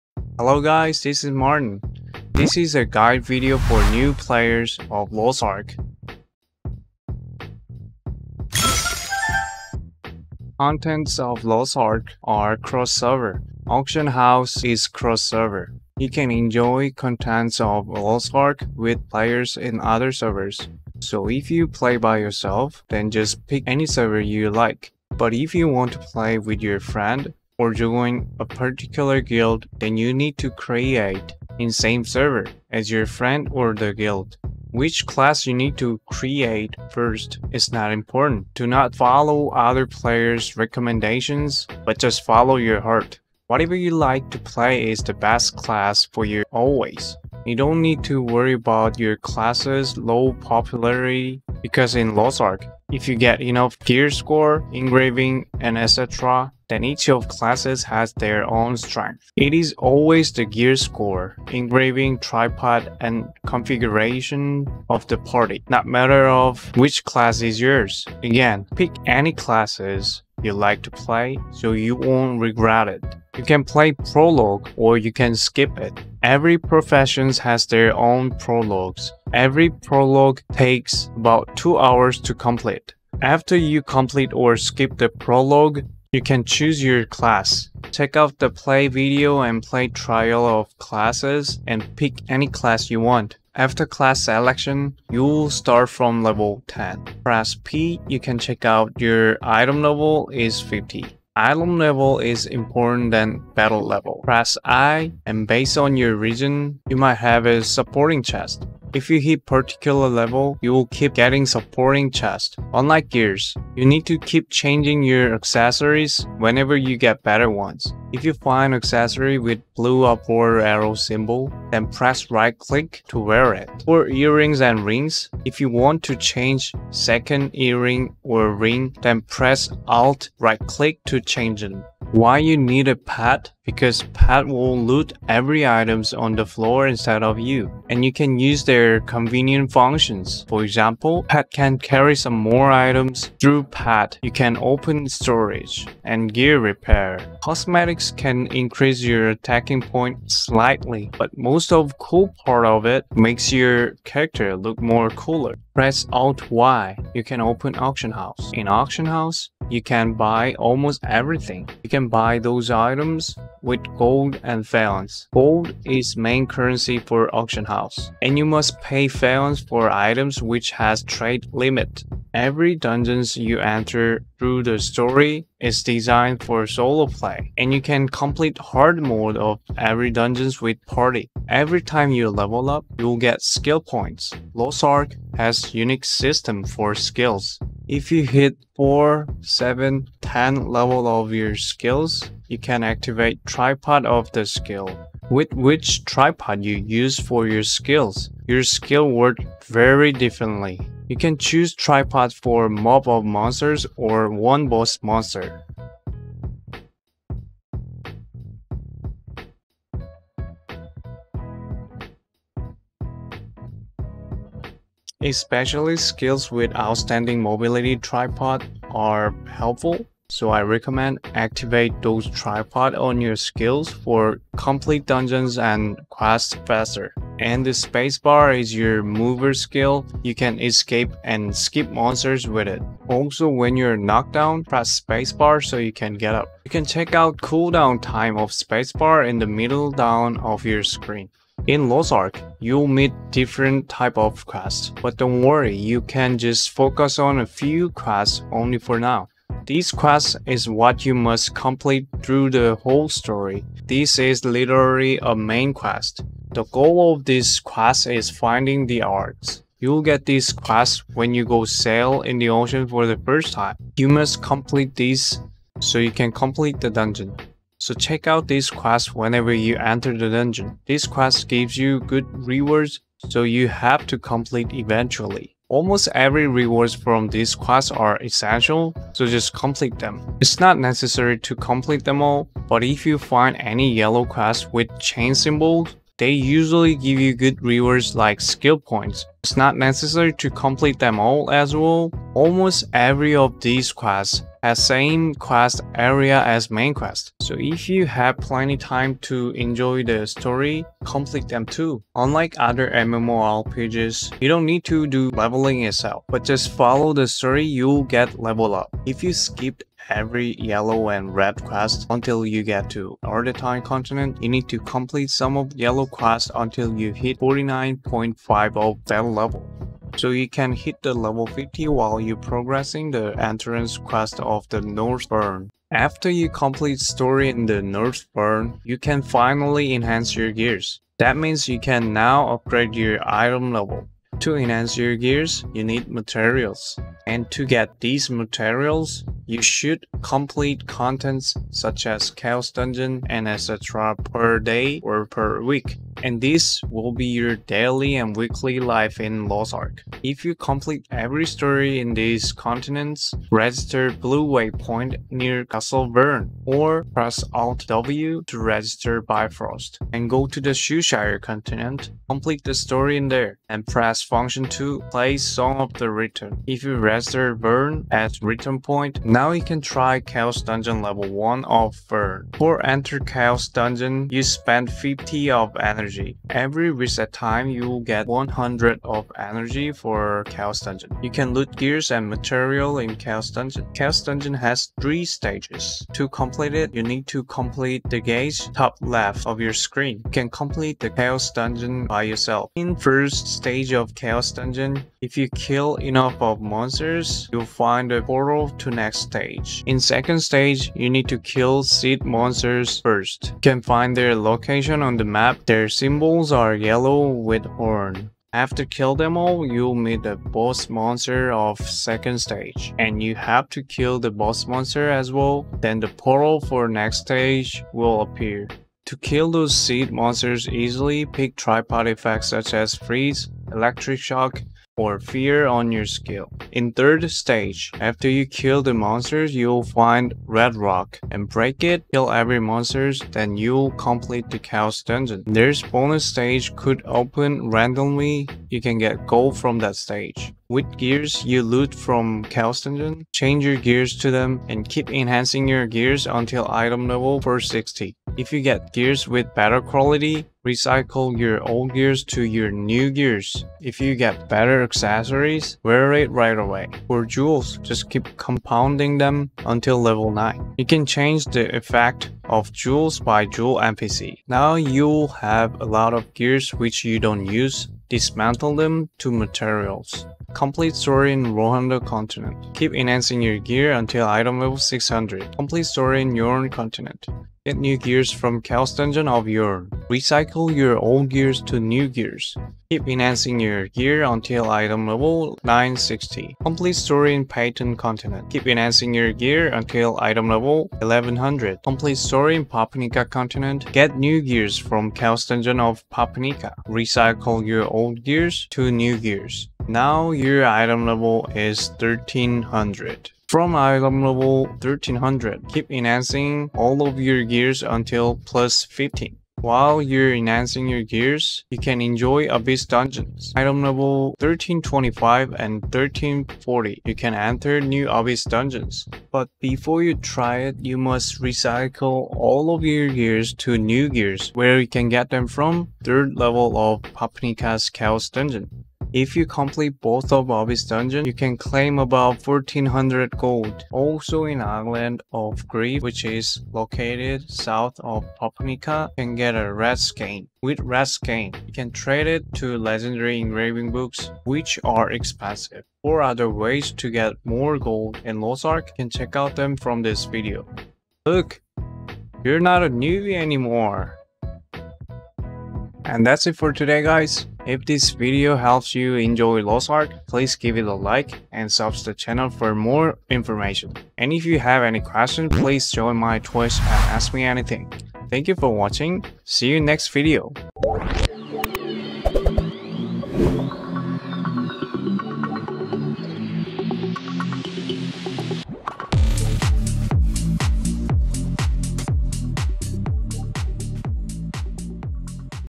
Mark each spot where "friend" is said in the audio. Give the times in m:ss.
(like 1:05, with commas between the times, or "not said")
0:26, 0:33.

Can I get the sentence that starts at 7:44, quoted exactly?
Now you'll have a lot of gears which you don't use.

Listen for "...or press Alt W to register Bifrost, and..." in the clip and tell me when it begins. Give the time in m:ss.
5:56.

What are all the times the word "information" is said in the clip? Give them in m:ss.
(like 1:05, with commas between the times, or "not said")
9:23.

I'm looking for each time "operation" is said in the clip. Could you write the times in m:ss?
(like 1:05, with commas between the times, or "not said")
not said.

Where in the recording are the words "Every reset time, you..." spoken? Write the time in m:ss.
6:16.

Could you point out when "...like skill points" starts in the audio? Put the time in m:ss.
4:48.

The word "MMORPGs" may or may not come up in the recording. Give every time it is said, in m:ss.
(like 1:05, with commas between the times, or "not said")
5:02.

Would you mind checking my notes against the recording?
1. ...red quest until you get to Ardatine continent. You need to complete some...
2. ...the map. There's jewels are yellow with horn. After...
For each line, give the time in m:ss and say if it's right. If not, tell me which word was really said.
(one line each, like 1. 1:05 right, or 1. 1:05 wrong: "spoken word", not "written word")
1. 5:11 right
2. 6:45 wrong: "symbols", not "jewels".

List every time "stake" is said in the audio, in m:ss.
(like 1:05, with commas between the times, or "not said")
not said.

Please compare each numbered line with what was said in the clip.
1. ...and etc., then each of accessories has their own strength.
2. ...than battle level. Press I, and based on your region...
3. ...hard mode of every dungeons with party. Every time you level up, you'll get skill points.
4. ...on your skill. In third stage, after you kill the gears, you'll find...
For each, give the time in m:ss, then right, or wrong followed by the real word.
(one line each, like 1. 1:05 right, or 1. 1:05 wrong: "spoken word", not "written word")
1. 0:55 wrong: "classes", not "accessories"
2. 1:43 right
3. 2:58 right
4. 7:05 wrong: "monsters", not "gears".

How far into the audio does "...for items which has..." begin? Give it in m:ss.
2:49.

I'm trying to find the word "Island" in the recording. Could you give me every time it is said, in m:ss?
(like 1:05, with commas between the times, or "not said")
8:54.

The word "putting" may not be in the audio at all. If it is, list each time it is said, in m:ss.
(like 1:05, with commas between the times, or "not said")
not said.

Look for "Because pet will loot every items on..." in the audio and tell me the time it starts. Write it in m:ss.
2:13.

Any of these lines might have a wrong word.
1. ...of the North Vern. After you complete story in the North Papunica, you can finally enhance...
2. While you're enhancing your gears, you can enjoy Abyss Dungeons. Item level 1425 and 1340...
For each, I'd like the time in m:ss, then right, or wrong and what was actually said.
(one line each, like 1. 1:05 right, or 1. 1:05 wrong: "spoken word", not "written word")
1. 5:24 wrong: "Vern", not "Papunica"
2. 8:29 wrong: "1325", not "1425".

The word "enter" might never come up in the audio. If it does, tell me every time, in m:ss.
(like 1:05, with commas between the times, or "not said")
2:53, 4:29, 6:12, 8:37.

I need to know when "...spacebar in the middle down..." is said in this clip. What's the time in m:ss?
3:58.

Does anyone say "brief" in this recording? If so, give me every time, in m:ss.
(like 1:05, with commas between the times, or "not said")
not said.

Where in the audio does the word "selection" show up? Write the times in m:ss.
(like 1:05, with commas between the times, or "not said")
1:34.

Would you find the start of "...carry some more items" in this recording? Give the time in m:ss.
2:21.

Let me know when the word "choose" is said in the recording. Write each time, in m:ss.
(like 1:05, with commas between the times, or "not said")
1:26, 3:21.